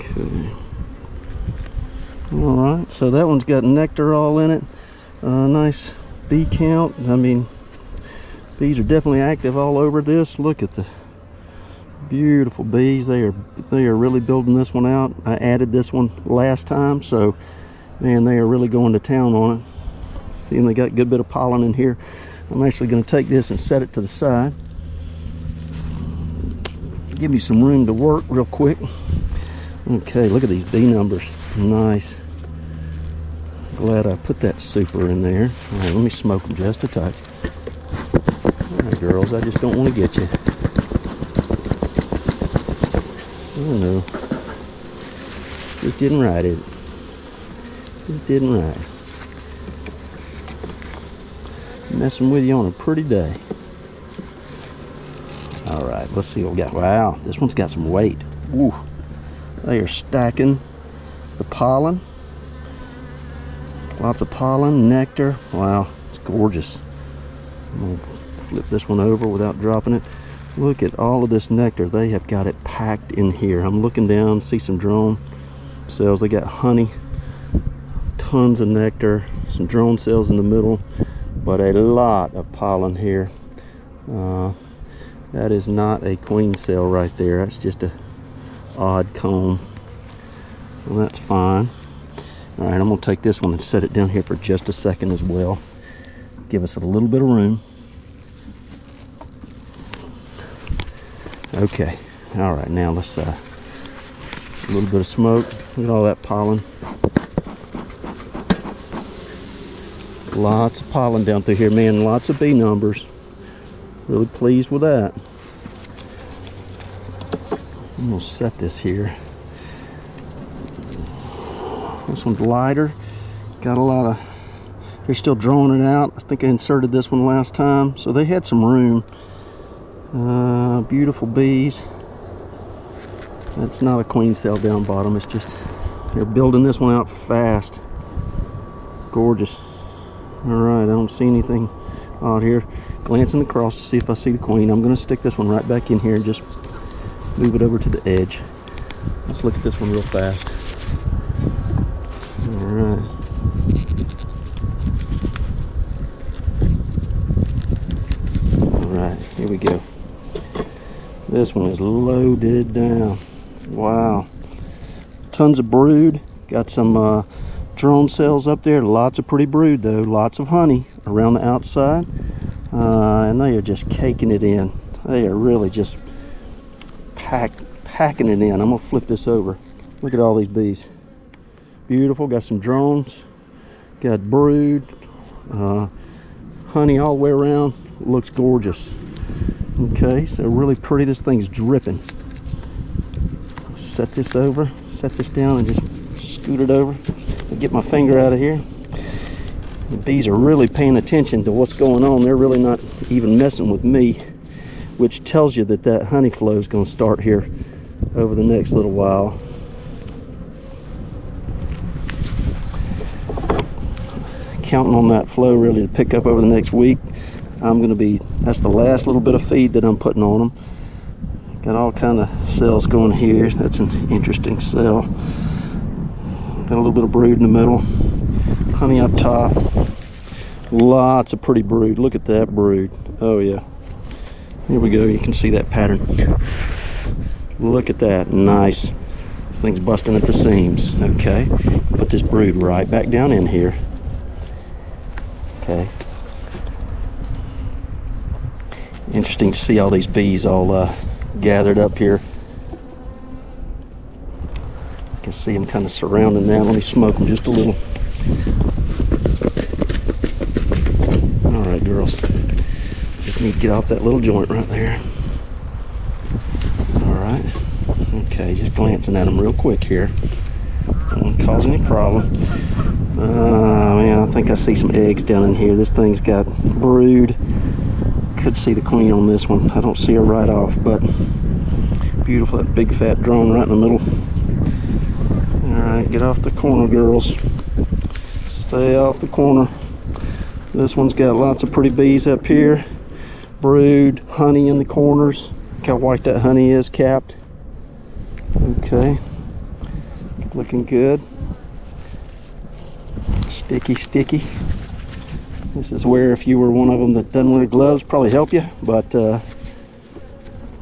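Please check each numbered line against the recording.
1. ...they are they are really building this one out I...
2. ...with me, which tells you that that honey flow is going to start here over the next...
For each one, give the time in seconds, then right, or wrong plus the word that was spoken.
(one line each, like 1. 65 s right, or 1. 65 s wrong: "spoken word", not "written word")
1. 13 s right
2. 203 s right.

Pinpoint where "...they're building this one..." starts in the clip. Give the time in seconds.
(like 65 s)
136 s.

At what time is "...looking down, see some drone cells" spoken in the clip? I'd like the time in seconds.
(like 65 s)
73 s.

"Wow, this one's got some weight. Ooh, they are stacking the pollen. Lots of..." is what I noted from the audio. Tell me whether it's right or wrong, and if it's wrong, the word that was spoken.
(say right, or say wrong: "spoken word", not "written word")
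right.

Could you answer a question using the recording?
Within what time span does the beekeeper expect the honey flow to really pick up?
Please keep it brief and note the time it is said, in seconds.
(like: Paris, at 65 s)
the next week, at 216 s.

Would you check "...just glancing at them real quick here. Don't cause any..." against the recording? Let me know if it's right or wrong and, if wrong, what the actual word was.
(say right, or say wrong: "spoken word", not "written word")
right.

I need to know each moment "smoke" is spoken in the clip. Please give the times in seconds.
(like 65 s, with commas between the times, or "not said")
36 s, 105 s, 256 s.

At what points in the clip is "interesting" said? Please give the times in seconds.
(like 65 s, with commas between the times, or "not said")
224 s, 249 s.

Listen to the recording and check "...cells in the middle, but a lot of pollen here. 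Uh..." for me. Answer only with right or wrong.
right.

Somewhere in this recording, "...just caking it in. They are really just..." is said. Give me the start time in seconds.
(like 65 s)
173 s.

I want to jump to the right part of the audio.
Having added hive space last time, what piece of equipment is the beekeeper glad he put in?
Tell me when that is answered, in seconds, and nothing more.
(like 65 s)
34 s.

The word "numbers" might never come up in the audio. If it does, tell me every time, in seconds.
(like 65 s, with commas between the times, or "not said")
30 s, 112 s.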